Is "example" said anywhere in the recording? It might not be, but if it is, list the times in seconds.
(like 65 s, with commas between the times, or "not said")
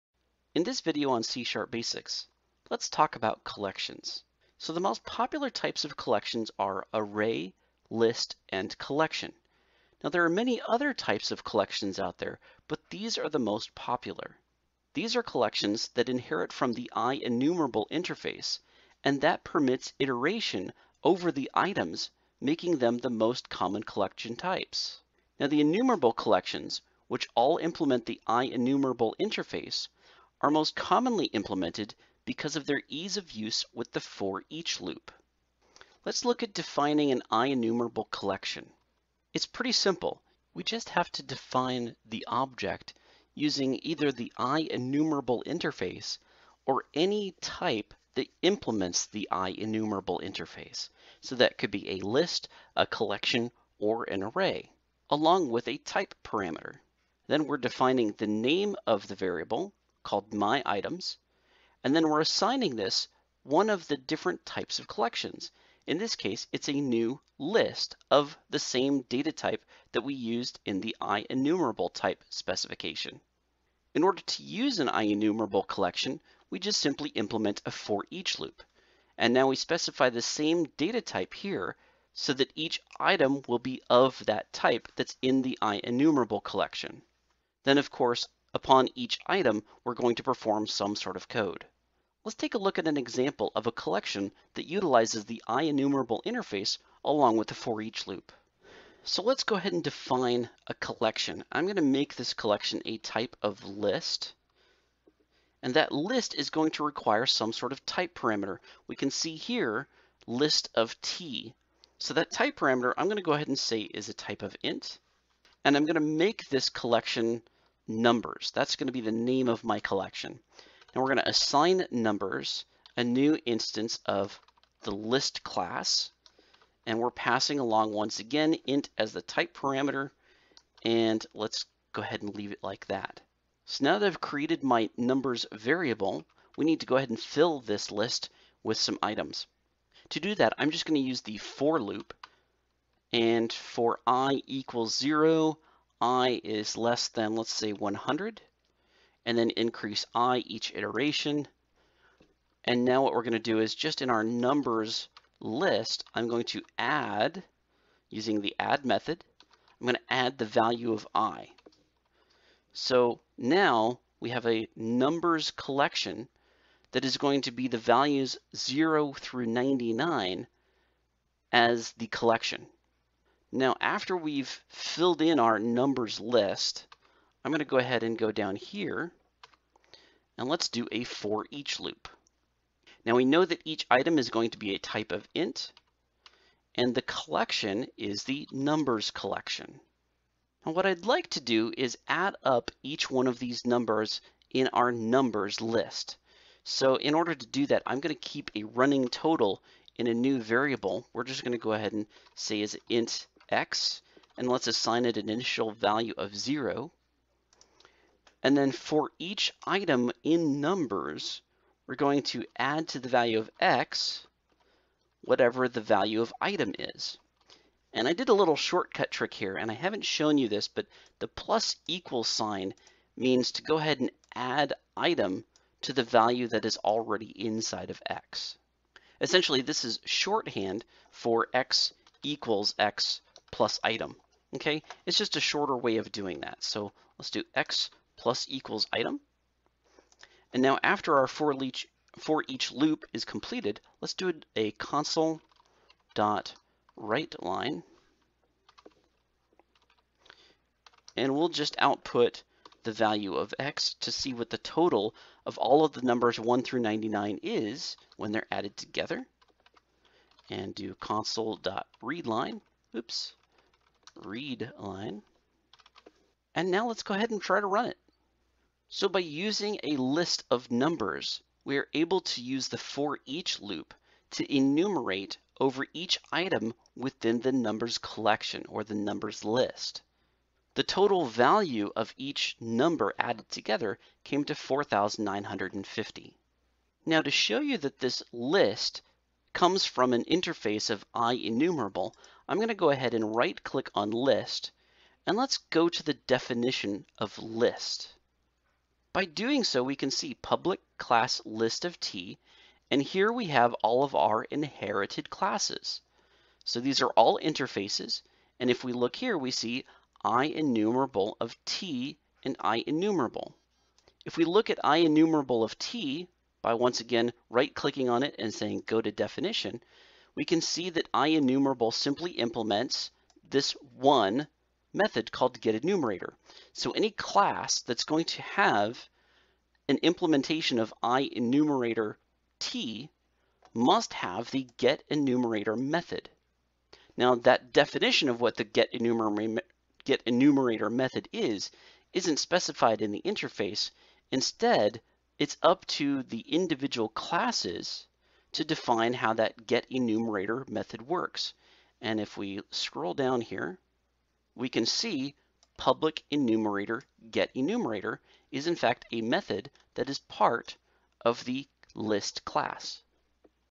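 92 s.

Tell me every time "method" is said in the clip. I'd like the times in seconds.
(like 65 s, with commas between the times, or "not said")
158 s, 324 s, 335 s, 340 s, 350 s, 359 s.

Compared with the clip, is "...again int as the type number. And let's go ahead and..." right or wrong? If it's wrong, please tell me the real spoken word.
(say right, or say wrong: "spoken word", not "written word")
wrong: "parameter", not "number".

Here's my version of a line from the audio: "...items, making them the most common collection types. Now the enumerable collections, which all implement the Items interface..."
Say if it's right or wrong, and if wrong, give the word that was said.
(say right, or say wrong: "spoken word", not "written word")
wrong: "IEnumerable", not "Items".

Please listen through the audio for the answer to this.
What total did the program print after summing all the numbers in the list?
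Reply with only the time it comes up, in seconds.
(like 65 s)
284 s.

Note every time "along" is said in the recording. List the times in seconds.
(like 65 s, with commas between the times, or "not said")
55 s, 97 s, 127 s.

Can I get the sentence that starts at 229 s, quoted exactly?
Essentially, this is shorthand for x equals x plus item.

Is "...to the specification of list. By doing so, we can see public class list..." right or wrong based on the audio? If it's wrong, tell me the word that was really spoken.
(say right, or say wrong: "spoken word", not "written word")
wrong: "definition", not "specification".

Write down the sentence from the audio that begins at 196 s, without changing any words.
So in order to do that, I'm going to keep a running total in a new variable.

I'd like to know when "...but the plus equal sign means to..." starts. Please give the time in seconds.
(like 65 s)
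220 s.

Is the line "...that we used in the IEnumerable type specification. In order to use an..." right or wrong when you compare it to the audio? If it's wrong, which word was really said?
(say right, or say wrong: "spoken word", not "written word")
right.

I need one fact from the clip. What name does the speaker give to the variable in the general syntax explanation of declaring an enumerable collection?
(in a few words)
My Items.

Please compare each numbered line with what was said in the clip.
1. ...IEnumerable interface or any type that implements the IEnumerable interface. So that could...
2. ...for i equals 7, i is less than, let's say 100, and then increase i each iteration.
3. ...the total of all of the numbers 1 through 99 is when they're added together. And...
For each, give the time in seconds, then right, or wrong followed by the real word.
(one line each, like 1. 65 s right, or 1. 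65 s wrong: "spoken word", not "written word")
1. 44 s right
2. 143 s wrong: "0", not "7"
3. 254 s right.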